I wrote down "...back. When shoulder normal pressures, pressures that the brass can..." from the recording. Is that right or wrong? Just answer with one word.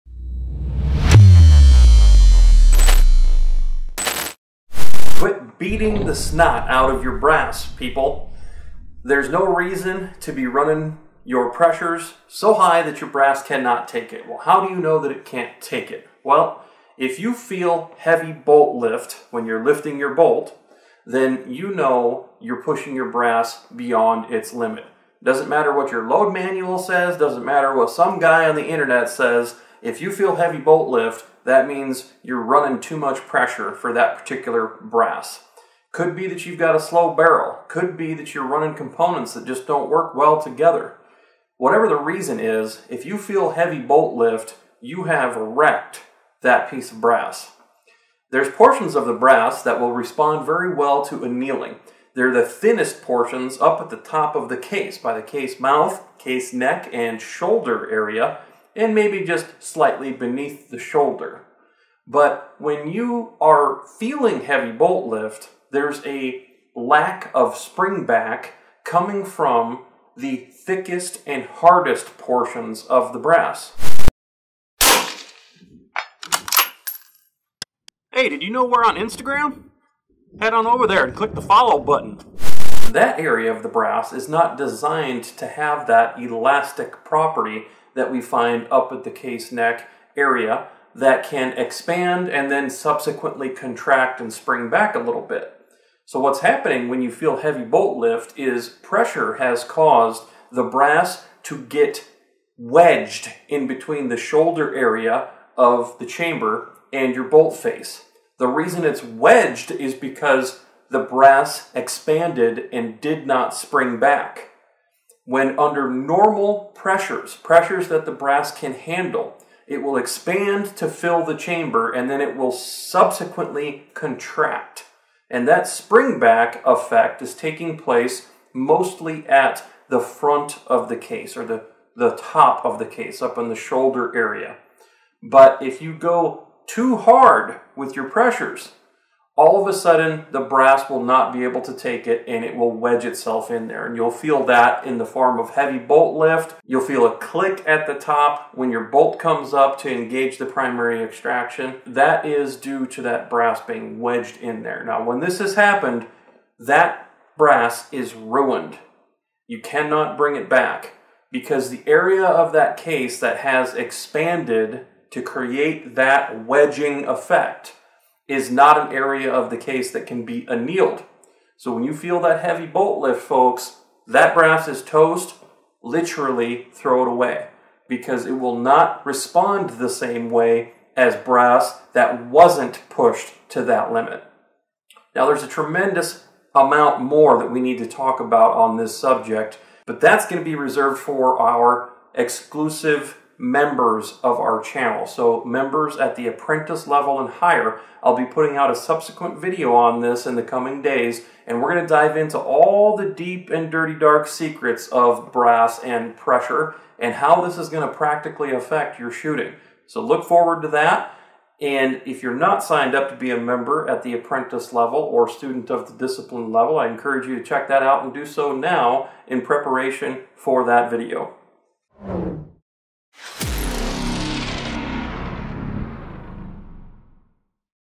wrong.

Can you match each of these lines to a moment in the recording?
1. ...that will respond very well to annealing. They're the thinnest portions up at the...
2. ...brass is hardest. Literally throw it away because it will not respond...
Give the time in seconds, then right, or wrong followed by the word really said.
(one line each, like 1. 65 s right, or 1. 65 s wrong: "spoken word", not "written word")
1. 49 s right
2. 174 s wrong: "toast", not "hardest".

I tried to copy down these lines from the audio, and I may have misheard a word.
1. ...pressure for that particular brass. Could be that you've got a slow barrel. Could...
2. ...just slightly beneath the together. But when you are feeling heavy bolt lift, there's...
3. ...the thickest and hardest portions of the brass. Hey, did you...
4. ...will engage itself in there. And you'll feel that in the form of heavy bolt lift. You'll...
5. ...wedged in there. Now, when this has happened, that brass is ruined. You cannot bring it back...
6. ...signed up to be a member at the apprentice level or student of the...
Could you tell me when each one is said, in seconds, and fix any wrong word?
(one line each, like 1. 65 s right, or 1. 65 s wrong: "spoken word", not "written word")
1. 33 s right
2. 59 s wrong: "shoulder", not "together"
3. 70 s right
4. 142 s wrong: "wedge", not "engage"
5. 153 s right
6. 212 s right.